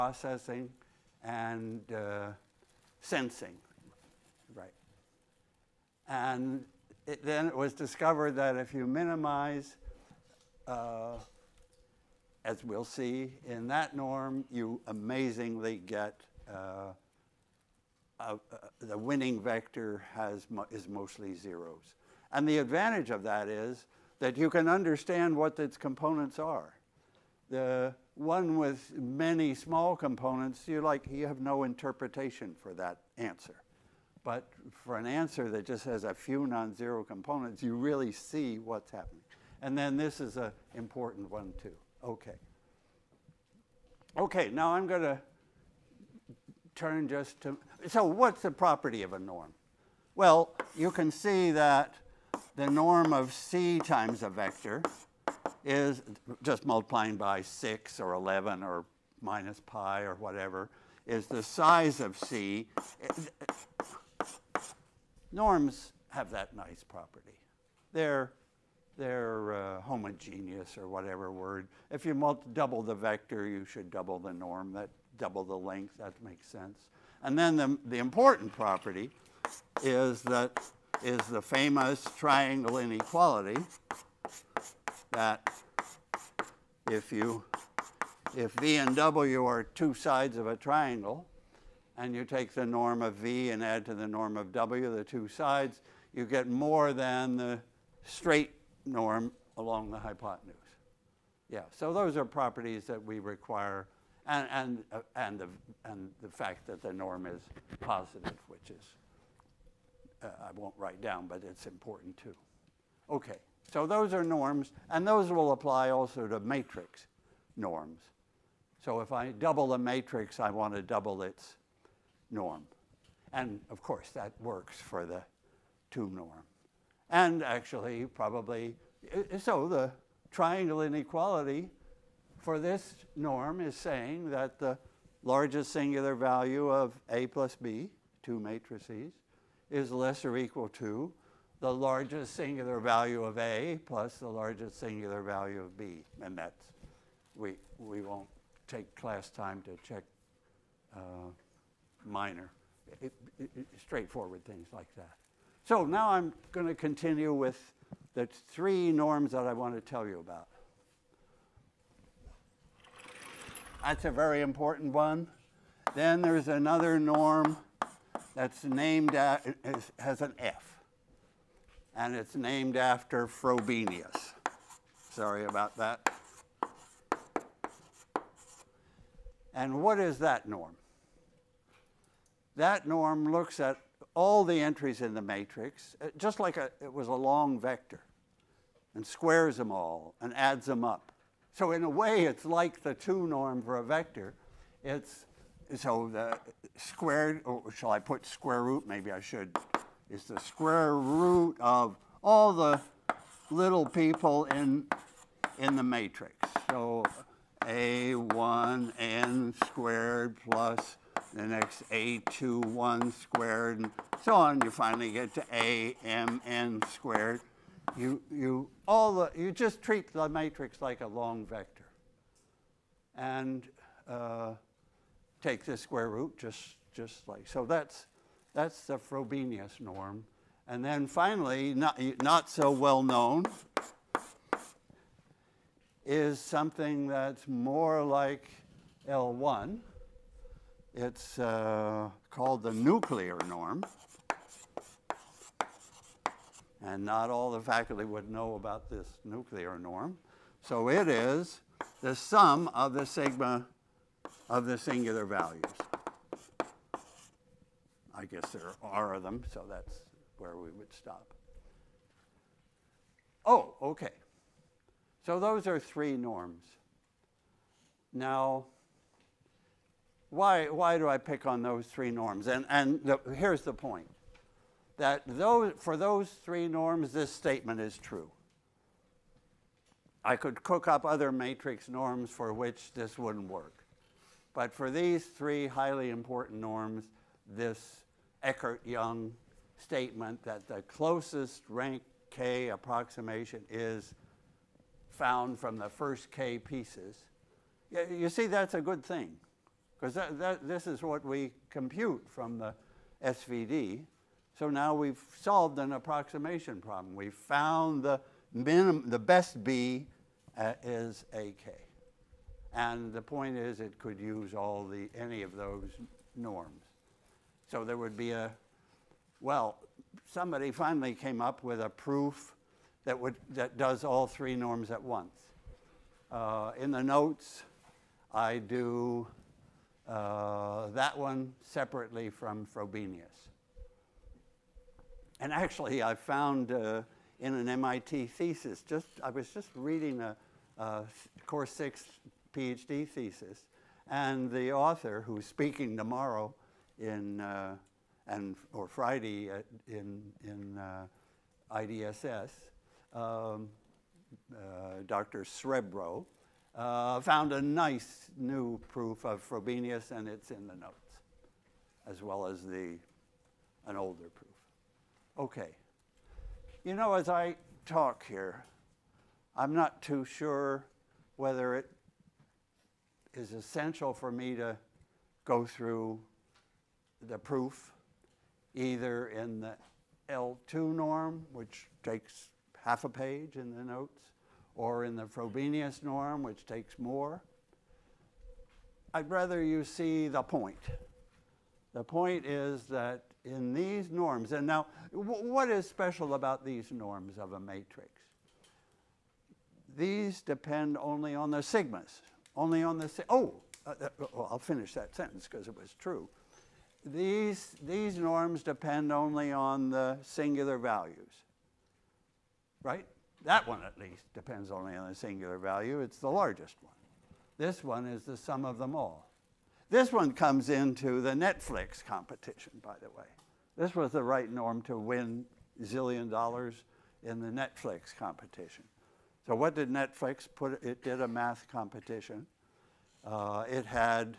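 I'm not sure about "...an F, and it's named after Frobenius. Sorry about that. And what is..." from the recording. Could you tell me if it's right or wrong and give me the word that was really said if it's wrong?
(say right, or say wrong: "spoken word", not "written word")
right.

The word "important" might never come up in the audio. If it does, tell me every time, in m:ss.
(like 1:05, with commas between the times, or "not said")
0:40, 1:17, 1:51, 2:44, 4:46.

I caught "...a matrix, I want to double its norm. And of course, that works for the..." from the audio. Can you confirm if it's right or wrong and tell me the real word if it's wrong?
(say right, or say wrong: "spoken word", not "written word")
right.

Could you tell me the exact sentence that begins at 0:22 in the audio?
And the advantage of that is that you can understand what its components are.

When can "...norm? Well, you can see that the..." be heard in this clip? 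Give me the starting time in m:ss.
0:49.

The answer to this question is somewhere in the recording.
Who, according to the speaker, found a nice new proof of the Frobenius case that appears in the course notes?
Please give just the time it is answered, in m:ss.
5:55.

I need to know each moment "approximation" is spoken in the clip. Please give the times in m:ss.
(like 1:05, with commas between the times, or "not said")
4:52, 5:05.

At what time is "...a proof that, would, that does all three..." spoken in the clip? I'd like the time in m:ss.
5:21.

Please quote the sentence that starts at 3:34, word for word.
You finally get to a m n squared.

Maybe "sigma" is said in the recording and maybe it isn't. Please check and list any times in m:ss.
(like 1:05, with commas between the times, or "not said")
4:13, 6:41.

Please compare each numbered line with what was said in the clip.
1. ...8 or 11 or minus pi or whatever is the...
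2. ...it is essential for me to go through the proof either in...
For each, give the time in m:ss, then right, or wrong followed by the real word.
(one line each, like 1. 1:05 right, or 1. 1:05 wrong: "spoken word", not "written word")
1. 0:57 wrong: "6", not "8"
2. 6:11 right.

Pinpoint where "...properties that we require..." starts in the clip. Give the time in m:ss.
1:42.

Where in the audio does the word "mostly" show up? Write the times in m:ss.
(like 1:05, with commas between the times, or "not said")
0:20.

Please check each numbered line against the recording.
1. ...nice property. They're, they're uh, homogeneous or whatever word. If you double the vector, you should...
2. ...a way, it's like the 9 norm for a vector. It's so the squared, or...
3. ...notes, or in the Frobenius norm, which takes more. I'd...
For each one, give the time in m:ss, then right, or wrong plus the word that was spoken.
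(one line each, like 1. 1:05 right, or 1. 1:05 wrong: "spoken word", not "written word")
1. 1:06 right
2. 3:11 wrong: "2", not "9"
3. 6:23 right.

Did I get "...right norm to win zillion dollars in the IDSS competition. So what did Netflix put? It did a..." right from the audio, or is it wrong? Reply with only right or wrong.
wrong.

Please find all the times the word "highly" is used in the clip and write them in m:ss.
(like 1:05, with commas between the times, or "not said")
4:45.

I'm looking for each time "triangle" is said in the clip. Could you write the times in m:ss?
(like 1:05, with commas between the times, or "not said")
1:22, 1:30, 2:10.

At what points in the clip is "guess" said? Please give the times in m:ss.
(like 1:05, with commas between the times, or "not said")
4:18.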